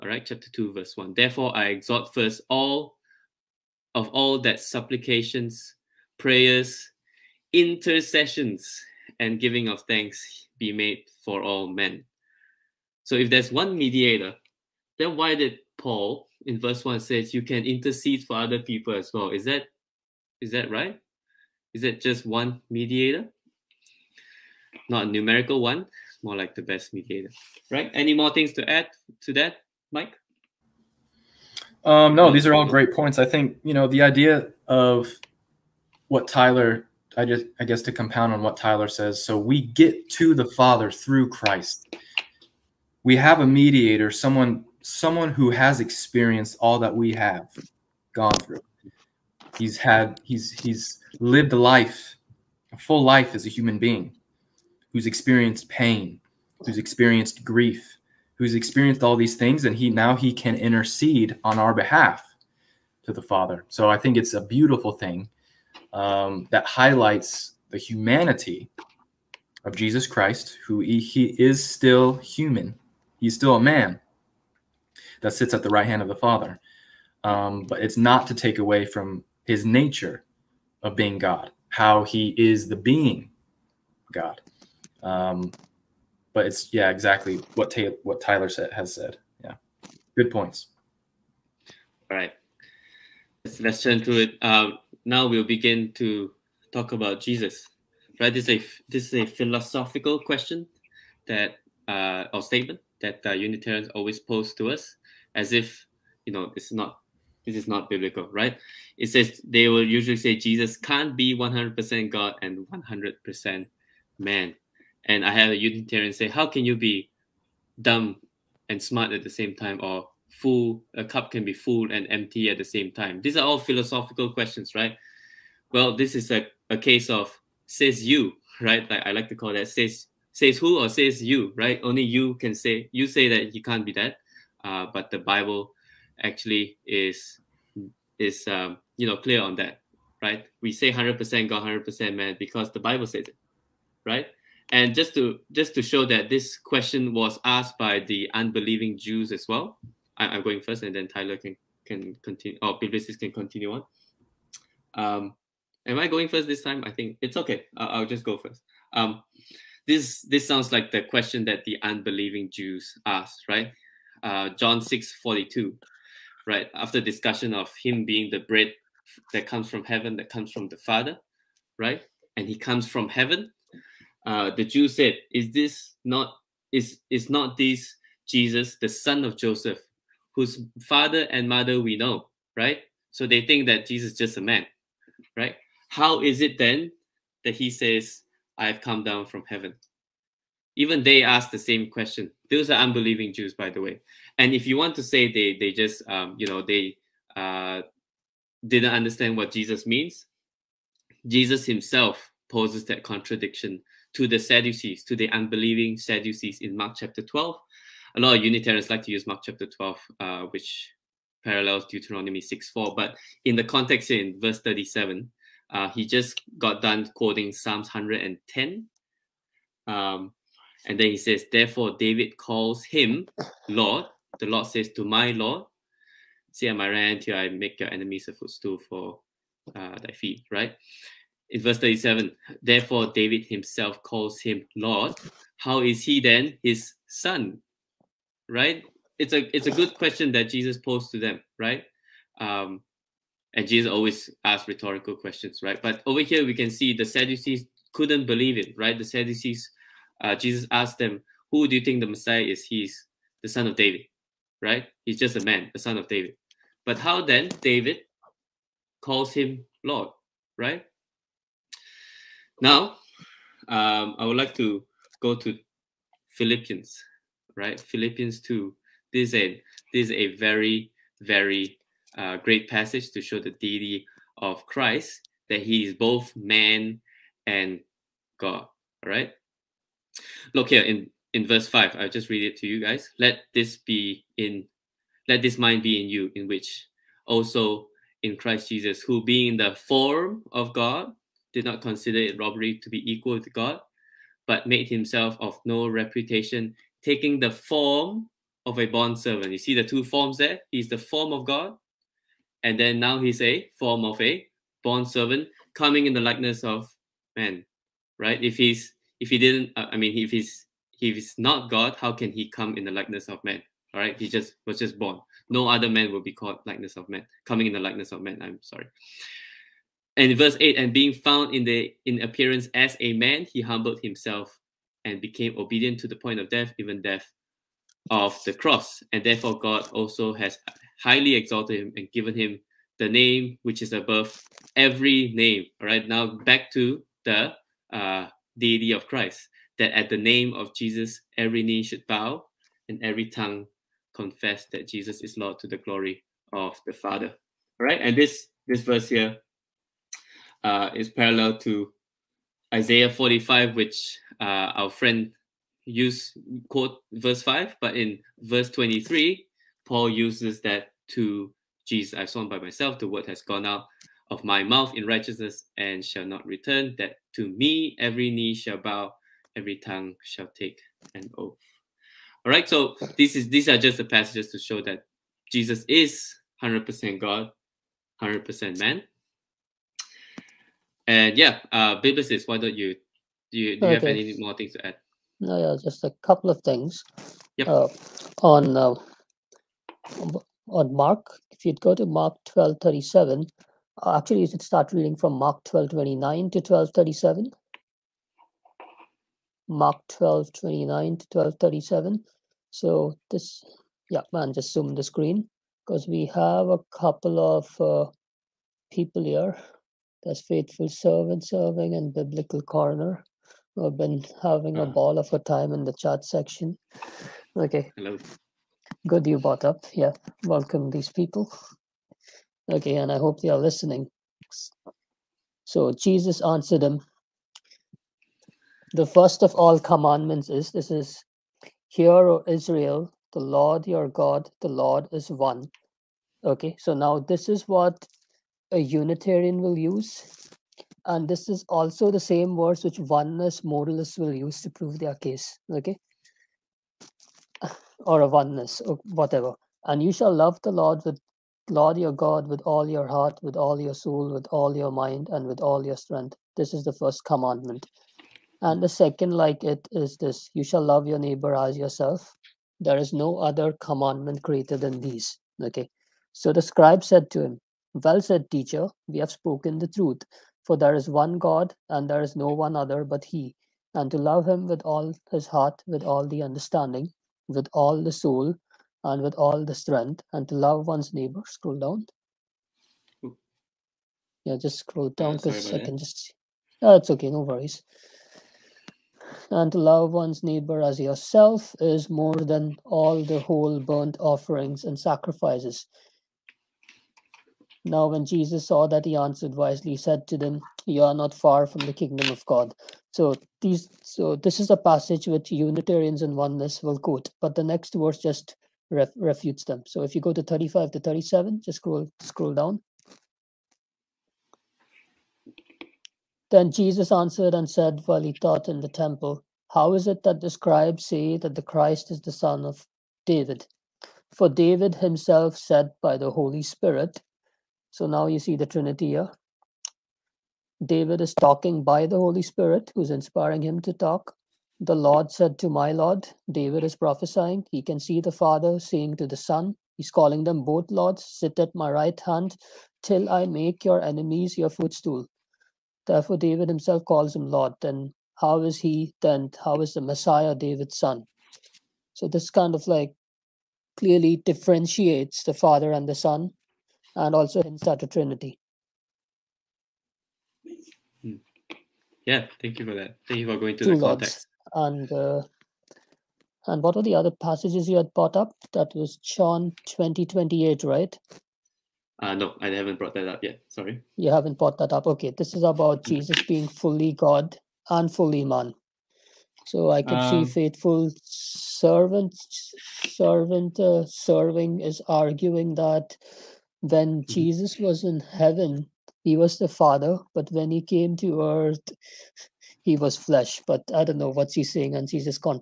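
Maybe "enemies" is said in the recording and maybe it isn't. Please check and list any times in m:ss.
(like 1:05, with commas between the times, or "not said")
3:47, 9:04.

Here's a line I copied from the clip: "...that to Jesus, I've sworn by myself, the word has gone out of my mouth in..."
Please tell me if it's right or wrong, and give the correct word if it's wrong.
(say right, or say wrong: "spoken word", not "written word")
right.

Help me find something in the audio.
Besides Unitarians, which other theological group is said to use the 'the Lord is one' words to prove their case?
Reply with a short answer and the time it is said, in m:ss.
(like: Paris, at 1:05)
oneness modalists, at 7:22.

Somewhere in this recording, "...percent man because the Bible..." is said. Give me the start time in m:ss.
2:21.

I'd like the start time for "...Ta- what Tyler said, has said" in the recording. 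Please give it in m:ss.
1:27.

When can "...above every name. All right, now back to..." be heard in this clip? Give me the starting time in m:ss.
5:33.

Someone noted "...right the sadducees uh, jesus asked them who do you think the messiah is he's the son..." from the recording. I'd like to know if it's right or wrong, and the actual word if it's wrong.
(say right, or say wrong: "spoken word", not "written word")
right.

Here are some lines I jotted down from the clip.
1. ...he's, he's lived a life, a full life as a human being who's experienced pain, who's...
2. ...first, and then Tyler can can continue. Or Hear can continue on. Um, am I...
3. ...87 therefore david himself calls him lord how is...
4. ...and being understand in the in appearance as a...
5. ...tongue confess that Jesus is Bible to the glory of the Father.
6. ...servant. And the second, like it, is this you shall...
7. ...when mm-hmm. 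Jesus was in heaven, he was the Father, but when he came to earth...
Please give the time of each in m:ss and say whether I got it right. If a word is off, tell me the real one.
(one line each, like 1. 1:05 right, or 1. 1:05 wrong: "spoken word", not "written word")
1. 0:50 right
2. 2:30 wrong: "Biblicist", not "Hear"
3. 3:51 wrong: "37", not "87"
4. 5:20 wrong: "found", not "understand"
5. 5:43 wrong: "Lord", not "Bible"
6. 7:37 wrong: "commandment", not "servant"
7. 9:46 right.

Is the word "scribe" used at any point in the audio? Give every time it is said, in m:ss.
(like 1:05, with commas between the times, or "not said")
7:46, 8:40.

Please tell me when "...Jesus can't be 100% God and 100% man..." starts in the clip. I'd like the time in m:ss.
1:50.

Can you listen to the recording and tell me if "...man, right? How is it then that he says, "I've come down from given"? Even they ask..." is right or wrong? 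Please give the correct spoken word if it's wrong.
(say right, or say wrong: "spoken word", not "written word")
wrong: "heaven", not "given".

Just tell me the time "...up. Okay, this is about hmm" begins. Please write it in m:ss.
9:34.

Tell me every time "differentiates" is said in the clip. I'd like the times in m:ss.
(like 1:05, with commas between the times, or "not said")
9:14.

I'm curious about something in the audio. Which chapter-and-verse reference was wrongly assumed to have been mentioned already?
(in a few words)
John 20:28.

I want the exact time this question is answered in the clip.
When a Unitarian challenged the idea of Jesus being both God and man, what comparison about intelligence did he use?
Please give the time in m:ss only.
1:57.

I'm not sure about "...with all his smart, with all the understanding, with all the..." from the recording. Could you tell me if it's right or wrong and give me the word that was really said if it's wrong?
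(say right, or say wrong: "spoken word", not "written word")
wrong: "heart", not "smart".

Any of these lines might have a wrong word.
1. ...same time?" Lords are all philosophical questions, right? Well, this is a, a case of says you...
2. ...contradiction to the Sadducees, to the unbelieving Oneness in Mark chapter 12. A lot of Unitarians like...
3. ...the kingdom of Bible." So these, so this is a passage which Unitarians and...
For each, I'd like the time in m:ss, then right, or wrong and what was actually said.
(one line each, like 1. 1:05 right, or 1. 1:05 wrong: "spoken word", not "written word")
1. 2:02 wrong: "These", not "Lords"
2. 3:23 wrong: "Sadducees", not "Oneness"
3. 8:21 wrong: "God", not "Bible".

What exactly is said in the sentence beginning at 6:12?
All right, so this is these are just the passages to show that Jesus is 100% God, 100% man.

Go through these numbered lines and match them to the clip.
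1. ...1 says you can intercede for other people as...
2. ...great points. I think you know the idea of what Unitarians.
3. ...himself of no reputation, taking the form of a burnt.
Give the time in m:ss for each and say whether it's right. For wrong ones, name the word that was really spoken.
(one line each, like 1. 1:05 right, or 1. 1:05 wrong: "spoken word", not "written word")
1. 0:16 right
2. 0:32 wrong: "Tyler", not "Unitarians"
3. 4:54 wrong: "bondservant", not "burnt".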